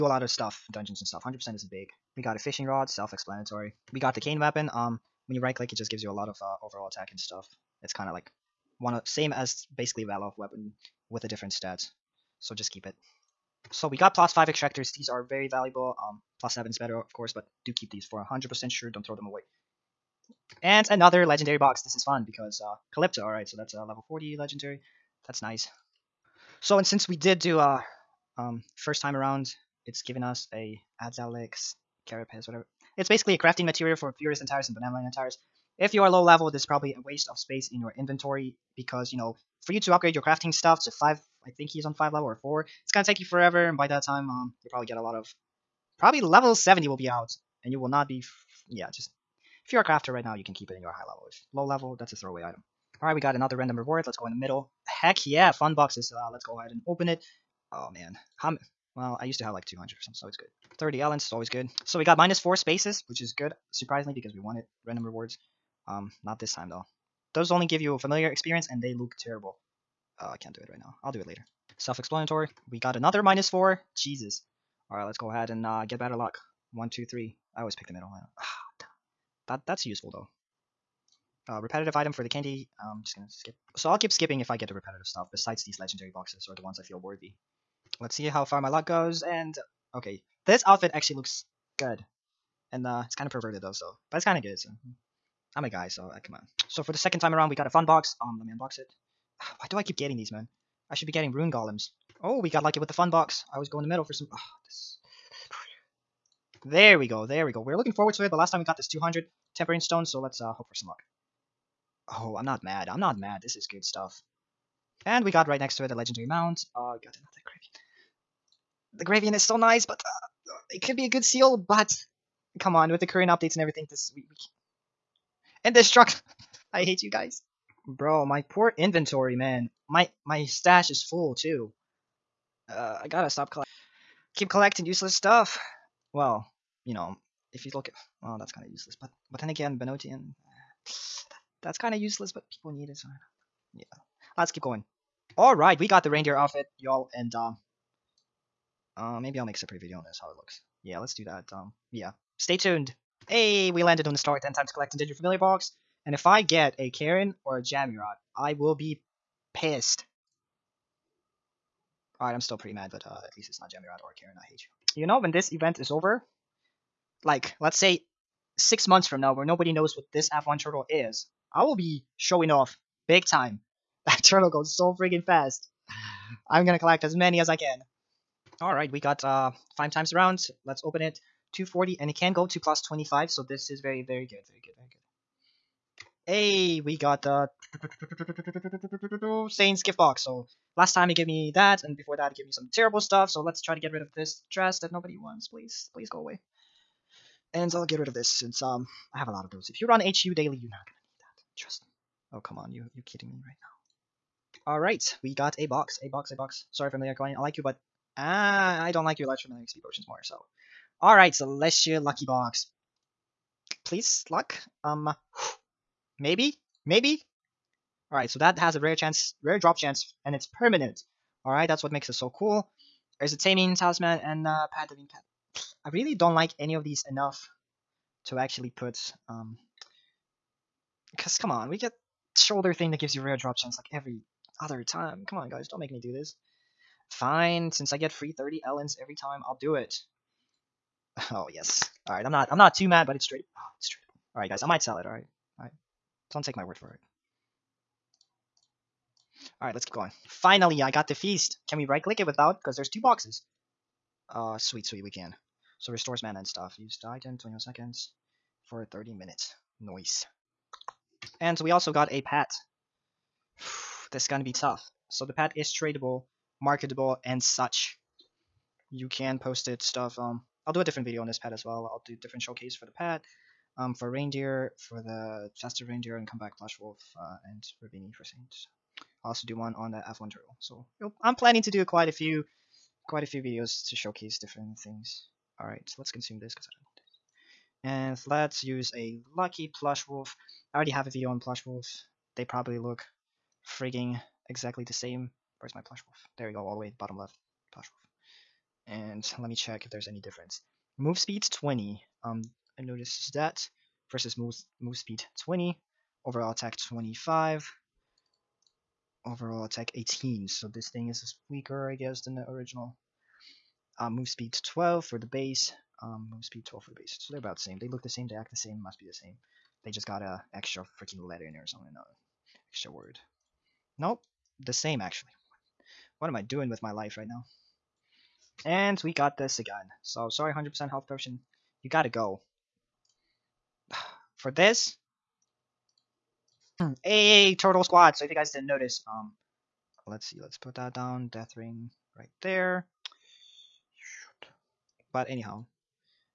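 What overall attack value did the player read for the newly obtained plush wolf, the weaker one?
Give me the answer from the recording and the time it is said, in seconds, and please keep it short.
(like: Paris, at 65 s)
18, at 309 s.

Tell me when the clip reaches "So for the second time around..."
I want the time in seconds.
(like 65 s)
96 s.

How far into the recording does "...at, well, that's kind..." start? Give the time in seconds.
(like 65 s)
137 s.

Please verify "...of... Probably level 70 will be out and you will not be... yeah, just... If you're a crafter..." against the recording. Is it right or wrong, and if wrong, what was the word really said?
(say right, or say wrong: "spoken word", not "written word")
right.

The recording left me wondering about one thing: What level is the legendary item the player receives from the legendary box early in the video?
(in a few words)
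40.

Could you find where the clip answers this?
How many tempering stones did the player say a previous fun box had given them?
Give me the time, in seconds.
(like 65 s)
108 s.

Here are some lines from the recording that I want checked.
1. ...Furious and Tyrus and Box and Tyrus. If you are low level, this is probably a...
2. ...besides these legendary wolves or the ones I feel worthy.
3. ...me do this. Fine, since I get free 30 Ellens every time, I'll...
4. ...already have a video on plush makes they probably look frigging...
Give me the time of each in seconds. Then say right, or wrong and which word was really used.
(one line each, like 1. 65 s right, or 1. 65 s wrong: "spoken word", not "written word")
1. 34 s wrong: "Banana", not "Box"
2. 85 s wrong: "boxes", not "wolves"
3. 235 s right
4. 290 s wrong: "wolves", not "makes".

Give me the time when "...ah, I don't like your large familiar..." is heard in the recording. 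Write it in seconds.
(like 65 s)
208 s.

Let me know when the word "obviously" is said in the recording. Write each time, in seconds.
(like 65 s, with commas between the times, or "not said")
not said.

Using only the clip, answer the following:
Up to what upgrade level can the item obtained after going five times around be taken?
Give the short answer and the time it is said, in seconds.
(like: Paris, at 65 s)
+25, at 182 s.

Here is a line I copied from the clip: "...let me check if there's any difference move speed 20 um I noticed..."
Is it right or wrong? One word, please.
right.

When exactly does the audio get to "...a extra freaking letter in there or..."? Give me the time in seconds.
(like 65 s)
320 s.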